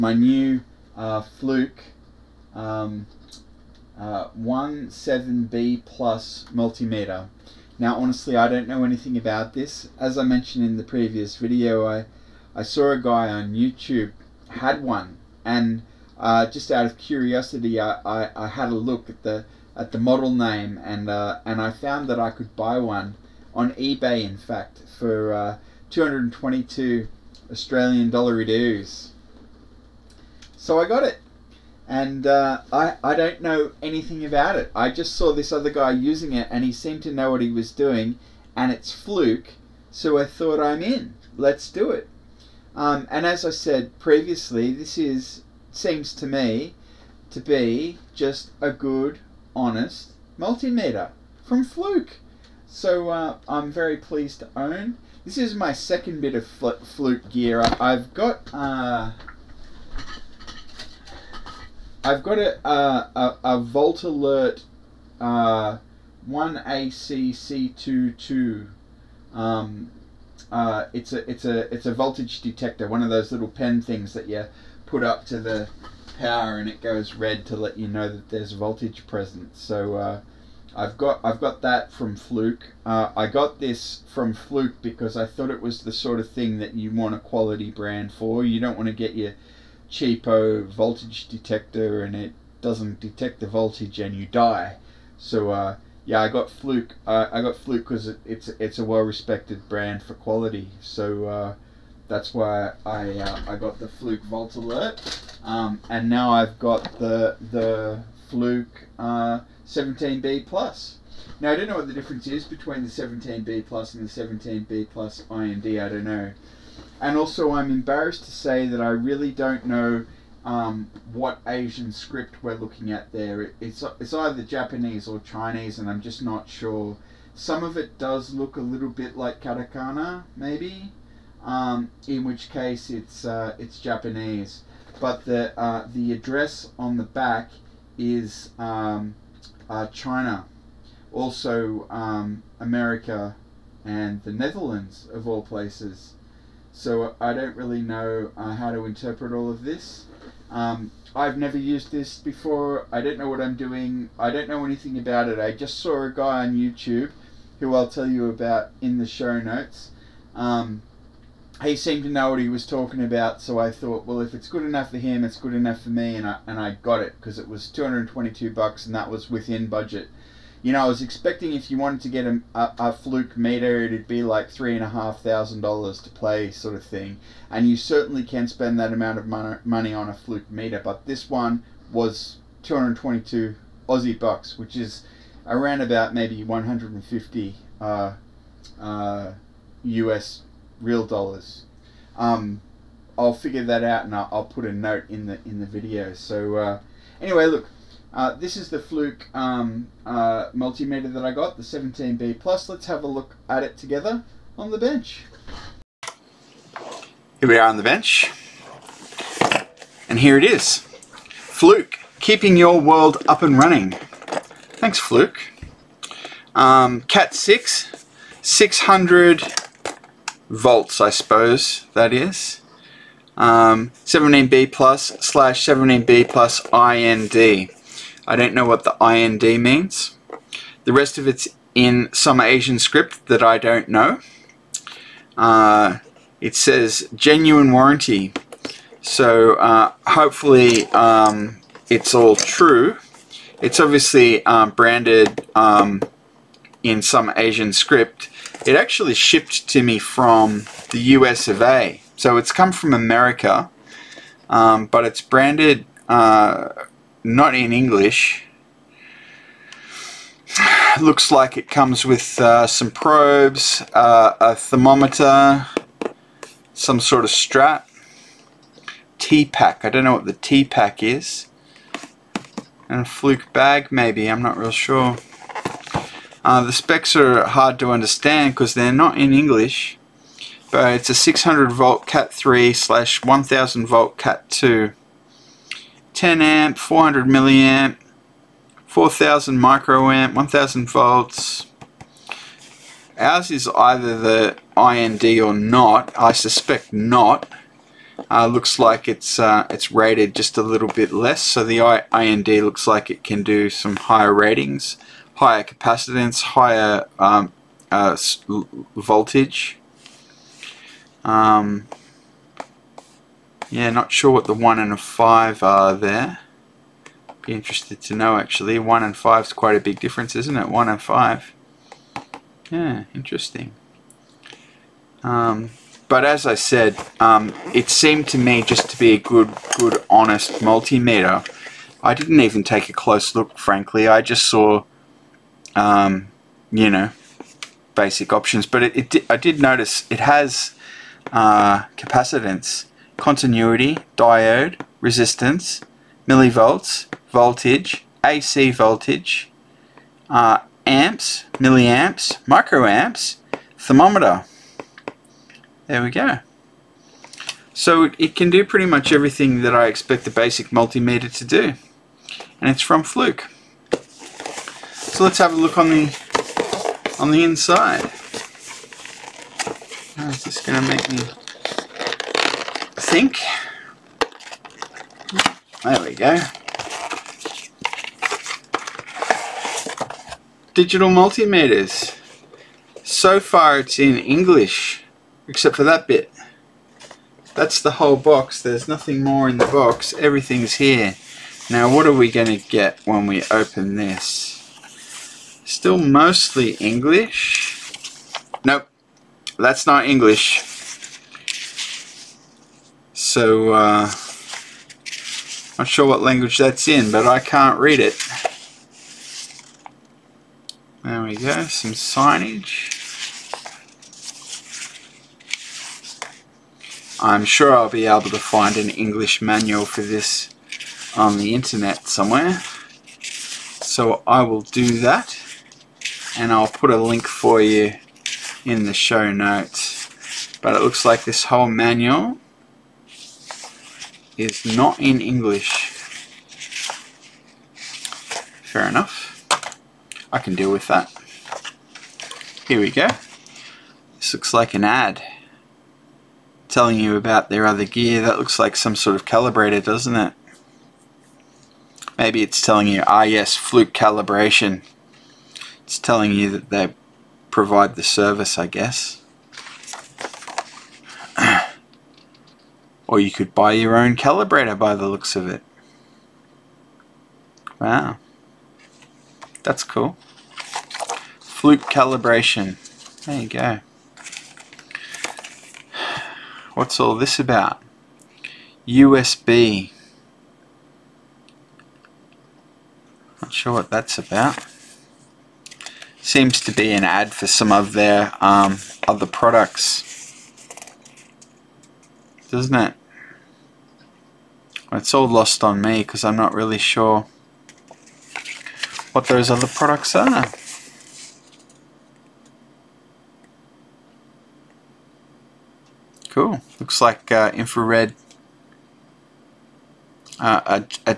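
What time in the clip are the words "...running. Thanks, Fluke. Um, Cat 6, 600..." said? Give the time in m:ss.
3:33.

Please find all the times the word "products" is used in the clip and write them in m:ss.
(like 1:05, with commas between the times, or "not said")
8:09, 8:19.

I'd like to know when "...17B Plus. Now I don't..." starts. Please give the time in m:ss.
1:49.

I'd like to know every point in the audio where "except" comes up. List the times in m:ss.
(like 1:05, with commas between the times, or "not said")
6:25.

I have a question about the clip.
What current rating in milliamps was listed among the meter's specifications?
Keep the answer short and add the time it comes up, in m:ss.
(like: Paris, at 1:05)
400 milliamp, at 4:46.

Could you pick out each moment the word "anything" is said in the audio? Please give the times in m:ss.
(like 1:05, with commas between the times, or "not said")
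0:08, 0:33, 2:34.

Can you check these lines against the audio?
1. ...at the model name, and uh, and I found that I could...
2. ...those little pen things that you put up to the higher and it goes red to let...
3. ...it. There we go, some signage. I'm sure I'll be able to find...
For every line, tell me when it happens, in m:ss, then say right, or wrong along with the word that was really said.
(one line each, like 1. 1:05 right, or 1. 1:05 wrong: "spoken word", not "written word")
1. 0:19 right
2. 1:13 wrong: "power", not "higher"
3. 6:47 right.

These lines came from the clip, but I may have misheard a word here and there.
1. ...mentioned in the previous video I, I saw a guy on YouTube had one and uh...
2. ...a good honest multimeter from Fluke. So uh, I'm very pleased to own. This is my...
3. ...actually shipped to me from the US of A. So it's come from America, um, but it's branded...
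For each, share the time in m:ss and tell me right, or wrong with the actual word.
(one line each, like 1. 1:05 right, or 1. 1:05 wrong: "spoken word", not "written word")
1. 0:10 right
2. 0:48 right
3. 4:08 right.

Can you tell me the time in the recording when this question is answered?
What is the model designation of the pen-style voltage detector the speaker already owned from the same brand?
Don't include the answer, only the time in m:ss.
1:06.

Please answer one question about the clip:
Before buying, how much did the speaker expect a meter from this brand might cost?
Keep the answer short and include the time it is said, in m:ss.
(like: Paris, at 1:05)
3500 dollars, at 2:54.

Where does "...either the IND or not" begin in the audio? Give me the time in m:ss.
4:53.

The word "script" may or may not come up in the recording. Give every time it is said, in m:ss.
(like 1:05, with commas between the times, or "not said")
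2:01, 3:52, 4:07.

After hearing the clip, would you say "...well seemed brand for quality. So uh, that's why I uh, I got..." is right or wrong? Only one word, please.
wrong.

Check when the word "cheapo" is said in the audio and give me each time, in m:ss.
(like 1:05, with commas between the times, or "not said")
1:29.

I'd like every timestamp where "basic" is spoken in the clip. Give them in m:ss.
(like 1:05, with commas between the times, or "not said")
5:37, 6:00.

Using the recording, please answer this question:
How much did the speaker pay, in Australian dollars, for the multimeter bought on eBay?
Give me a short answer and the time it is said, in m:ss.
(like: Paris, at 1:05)
222, at 0:25.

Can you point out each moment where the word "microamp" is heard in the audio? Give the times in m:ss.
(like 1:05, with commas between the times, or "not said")
4:49, 5:52.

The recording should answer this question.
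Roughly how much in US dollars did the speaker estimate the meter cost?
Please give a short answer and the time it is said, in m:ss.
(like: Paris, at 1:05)
150, at 3:06.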